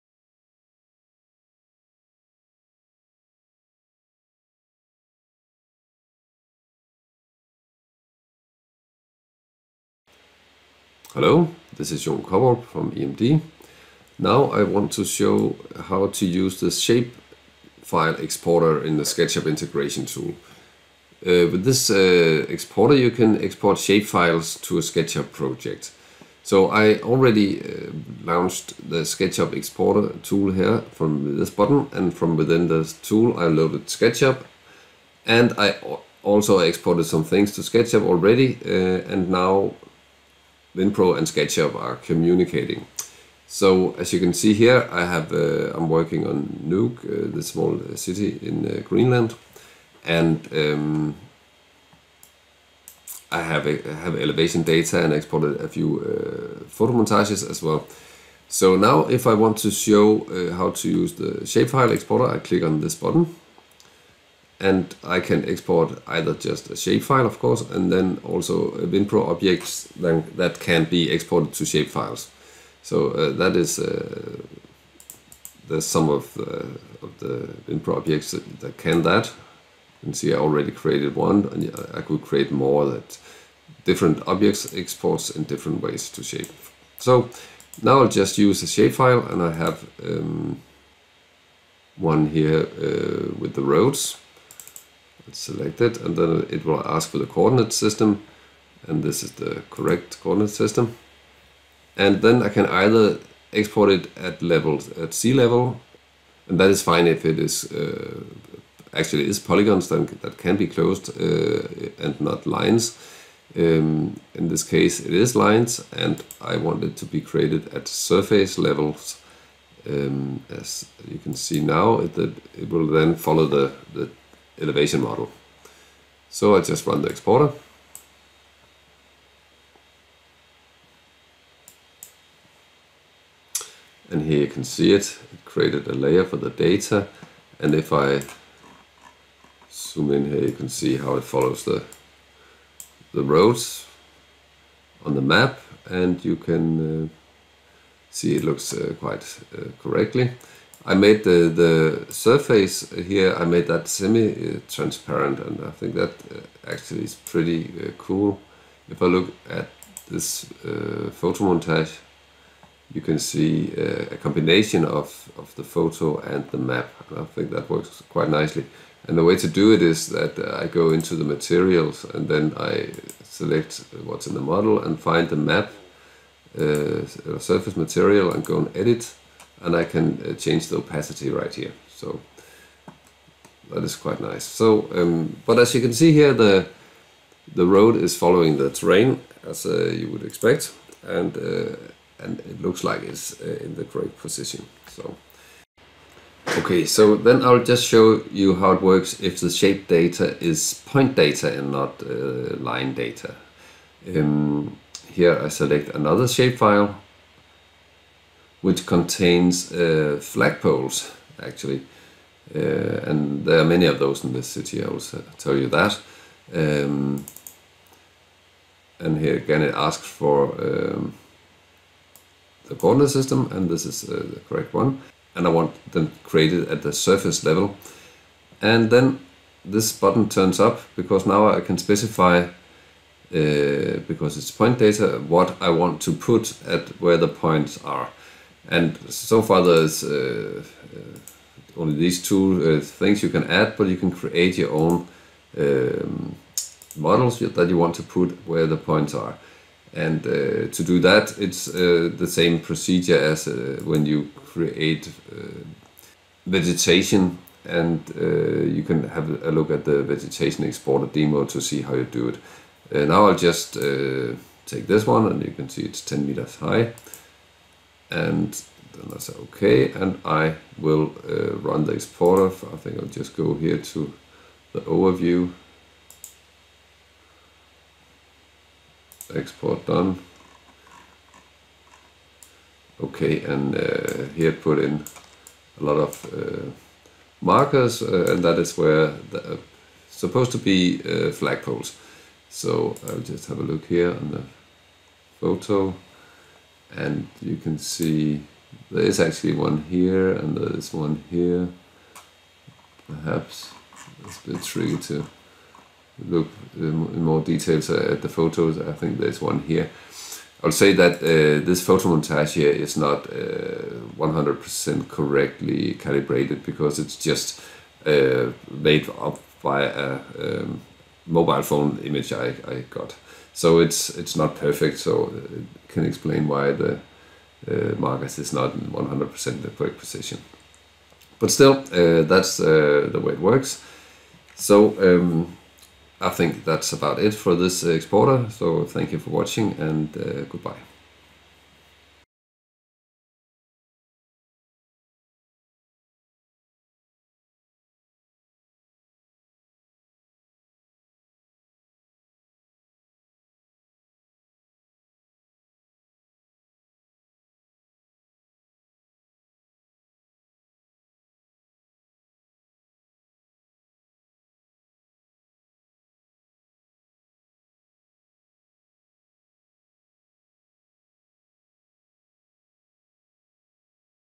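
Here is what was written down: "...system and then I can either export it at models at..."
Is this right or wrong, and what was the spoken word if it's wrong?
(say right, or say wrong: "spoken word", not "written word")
wrong: "levels", not "models".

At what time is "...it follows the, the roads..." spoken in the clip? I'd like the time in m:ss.
2:21.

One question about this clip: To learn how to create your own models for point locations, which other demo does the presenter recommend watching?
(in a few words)
vegetation exporter demo.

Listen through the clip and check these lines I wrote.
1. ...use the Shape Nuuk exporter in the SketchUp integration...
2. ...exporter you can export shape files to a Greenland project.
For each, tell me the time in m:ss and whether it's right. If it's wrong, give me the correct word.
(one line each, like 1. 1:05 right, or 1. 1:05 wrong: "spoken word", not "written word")
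1. 0:16 wrong: "File", not "Nuuk"
2. 0:22 wrong: "SketchUp", not "Greenland".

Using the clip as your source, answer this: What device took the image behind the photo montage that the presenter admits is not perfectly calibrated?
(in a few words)
mobile phone.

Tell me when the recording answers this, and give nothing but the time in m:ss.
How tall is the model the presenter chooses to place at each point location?
4:26.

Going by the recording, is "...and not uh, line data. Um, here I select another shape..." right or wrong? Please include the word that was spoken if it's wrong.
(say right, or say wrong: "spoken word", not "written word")
right.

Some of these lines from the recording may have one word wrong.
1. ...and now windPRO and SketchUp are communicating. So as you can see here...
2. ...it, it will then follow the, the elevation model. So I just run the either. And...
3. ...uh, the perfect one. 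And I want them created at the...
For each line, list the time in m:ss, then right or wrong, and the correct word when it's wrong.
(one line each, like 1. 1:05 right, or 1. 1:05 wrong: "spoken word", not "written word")
1. 0:39 right
2. 2:01 wrong: "exporter", not "either"
3. 3:44 wrong: "correct", not "perfect".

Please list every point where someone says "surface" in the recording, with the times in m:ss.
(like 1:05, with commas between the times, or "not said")
1:57, 2:32, 2:57, 3:46.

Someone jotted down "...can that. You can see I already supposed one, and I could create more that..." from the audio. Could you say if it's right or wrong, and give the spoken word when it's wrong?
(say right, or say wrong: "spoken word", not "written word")
wrong: "created", not "supposed".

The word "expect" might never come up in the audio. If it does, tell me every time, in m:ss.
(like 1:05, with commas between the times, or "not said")
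3:10.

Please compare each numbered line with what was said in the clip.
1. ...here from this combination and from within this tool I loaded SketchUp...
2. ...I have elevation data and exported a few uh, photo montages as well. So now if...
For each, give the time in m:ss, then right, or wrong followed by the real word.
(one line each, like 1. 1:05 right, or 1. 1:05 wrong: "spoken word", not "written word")
1. 0:30 wrong: "button", not "combination"
2. 0:53 right.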